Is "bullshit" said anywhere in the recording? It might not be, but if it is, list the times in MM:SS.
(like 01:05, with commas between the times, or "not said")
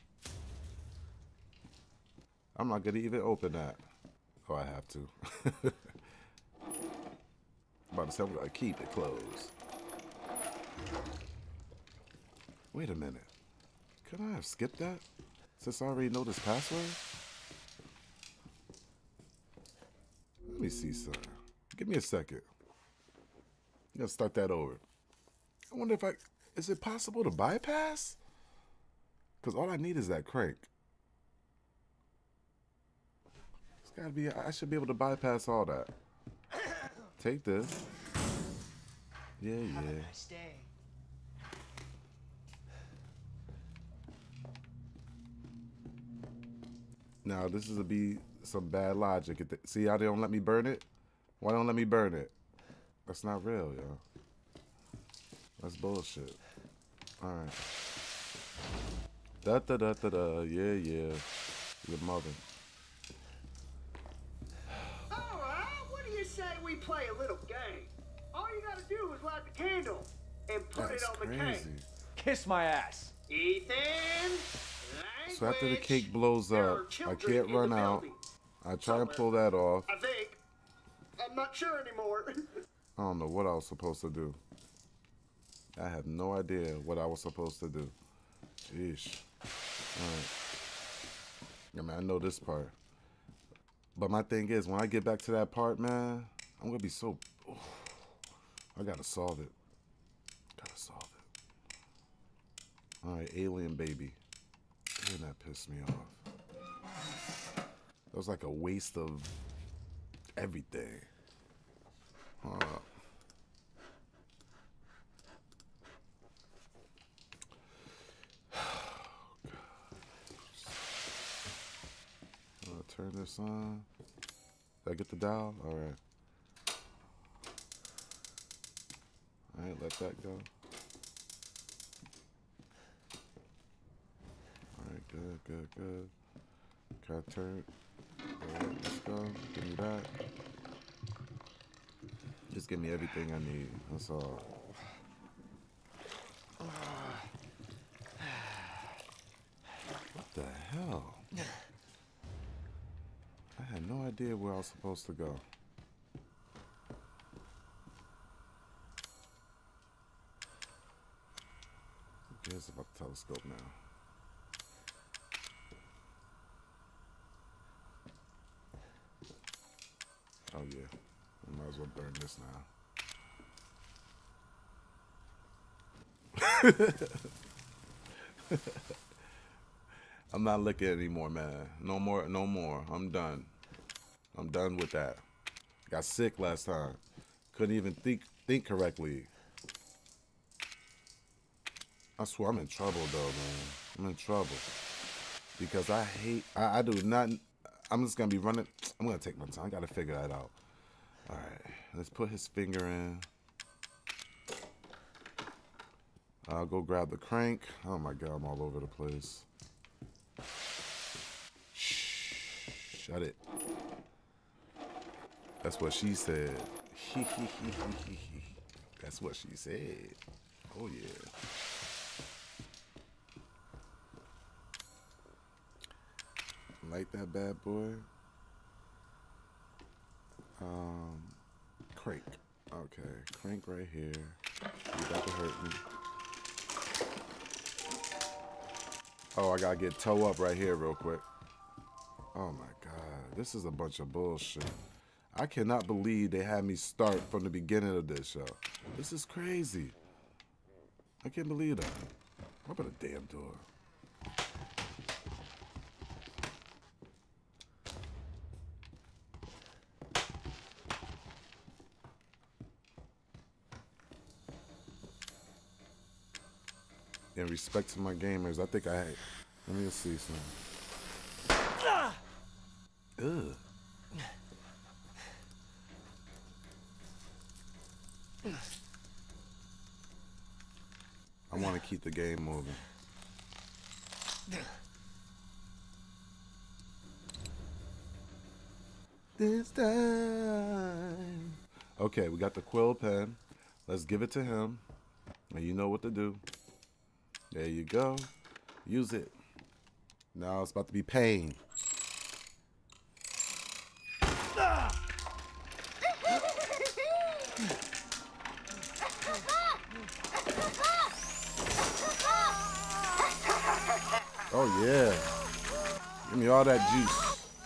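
00:55, 04:04.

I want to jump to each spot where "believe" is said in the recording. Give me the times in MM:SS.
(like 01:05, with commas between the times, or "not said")
04:05, 04:11.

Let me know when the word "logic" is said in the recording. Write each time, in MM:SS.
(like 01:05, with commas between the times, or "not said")
00:48.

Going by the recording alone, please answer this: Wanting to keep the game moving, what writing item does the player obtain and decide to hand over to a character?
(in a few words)
quill pen.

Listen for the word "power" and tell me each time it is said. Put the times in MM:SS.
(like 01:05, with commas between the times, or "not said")
not said.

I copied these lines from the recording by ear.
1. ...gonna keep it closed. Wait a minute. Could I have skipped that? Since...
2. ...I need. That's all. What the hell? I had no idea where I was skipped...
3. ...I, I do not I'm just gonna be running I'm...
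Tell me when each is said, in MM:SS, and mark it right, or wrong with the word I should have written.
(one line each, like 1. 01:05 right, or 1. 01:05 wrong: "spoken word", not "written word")
1. 00:08 right
2. 02:23 wrong: "supposed", not "skipped"
3. 03:16 right.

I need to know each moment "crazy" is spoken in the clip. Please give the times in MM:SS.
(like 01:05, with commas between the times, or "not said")
01:11, 04:09.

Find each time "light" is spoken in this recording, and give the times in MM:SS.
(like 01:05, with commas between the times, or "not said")
01:09, 03:46.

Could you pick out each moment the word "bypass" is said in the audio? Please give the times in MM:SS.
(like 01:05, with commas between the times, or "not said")
00:27, 00:34.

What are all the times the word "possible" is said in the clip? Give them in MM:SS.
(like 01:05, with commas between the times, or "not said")
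00:26.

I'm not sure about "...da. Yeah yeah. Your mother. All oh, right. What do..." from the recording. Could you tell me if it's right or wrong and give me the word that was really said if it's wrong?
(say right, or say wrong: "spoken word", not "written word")
right.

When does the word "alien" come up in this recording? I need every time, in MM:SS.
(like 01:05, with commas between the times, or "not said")
01:43.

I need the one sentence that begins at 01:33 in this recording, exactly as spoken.
But my thing is, when I get back to that part, man, I'm going to be so...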